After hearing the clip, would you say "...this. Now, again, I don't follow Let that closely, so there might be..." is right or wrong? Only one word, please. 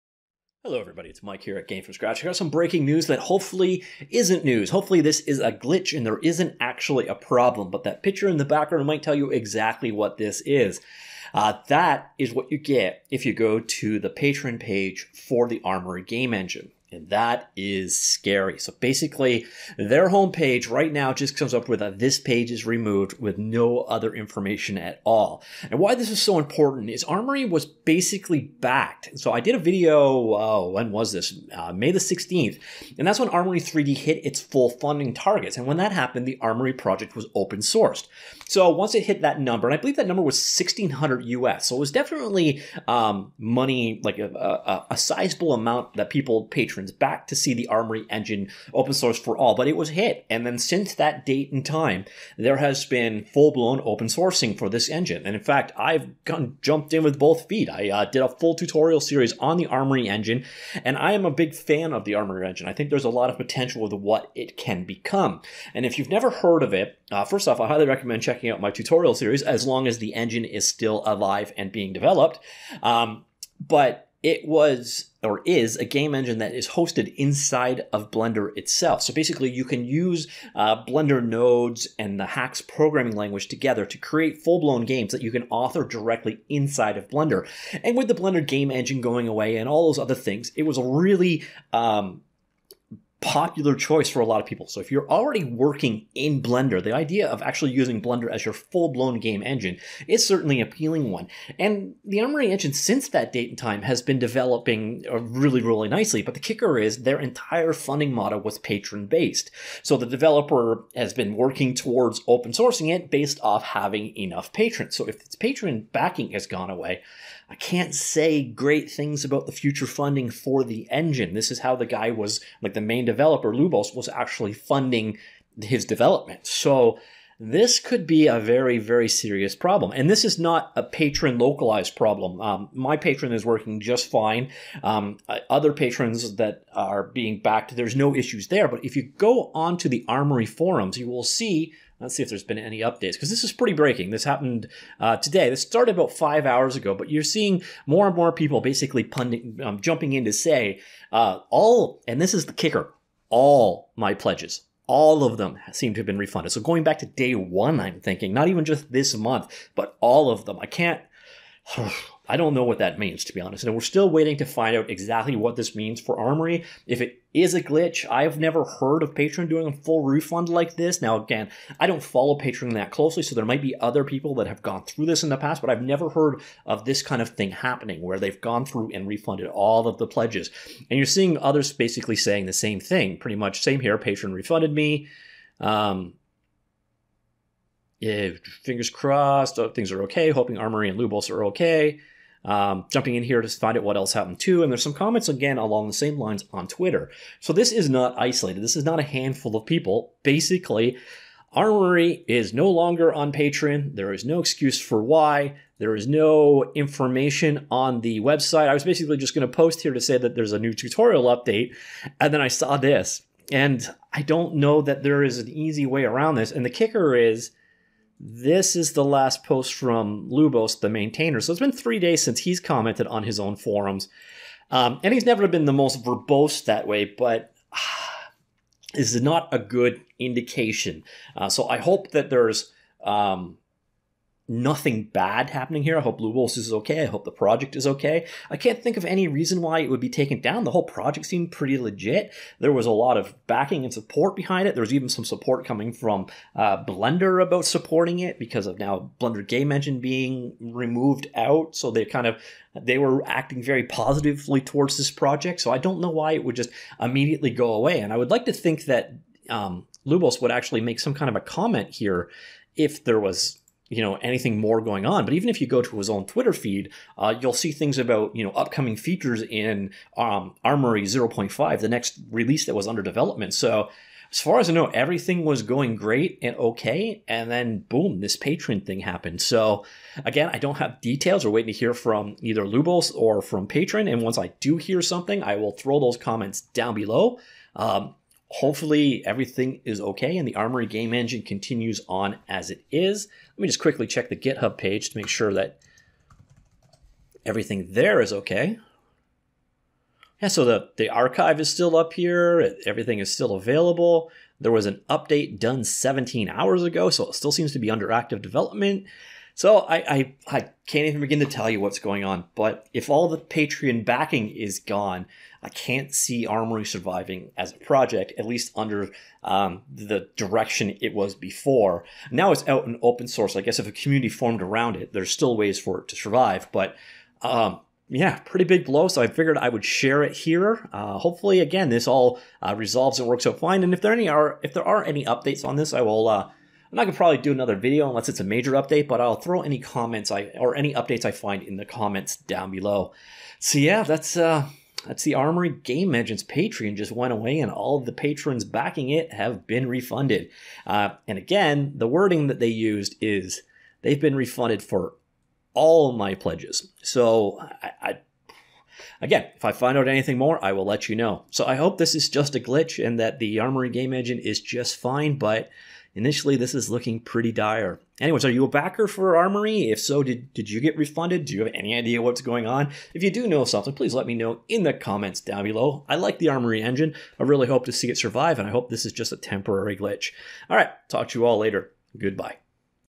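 wrong.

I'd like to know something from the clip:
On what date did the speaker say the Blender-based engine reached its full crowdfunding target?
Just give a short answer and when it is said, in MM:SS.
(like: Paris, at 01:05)
May 16, at 00:31.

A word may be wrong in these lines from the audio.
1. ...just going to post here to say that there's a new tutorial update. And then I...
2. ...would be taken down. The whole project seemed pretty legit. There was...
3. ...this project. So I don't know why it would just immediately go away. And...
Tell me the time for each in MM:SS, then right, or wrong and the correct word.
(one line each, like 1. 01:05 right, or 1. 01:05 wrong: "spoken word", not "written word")
1. 03:29 right
2. 03:59 right
3. 04:14 right.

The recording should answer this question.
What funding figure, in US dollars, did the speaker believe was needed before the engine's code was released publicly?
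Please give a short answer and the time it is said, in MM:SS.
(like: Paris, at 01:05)
1600, at 00:40.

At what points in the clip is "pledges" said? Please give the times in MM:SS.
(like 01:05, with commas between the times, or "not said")
02:34, 03:00, 05:56.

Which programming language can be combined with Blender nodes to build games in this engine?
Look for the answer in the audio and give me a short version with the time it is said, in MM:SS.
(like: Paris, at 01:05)
Haxe, at 01:22.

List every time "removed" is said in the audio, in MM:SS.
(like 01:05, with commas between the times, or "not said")
00:22, 04:10.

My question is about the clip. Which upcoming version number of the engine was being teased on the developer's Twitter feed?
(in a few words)
0.5.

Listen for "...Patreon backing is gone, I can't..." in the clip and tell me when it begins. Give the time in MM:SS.
05:13.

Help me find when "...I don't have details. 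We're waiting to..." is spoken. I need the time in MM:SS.
04:40.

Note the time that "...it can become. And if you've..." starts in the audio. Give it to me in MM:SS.
01:04.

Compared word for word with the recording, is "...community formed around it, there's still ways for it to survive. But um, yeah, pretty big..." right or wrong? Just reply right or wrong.
right.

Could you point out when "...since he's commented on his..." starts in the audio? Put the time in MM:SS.
03:42.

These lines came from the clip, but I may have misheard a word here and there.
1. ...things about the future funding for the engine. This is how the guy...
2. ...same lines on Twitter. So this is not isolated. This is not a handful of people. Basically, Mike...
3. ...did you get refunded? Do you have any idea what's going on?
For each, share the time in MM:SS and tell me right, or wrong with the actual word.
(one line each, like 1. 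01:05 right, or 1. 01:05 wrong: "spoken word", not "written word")
1. 01:58 right
2. 03:15 wrong: "Armory", not "Mike"
3. 06:10 right.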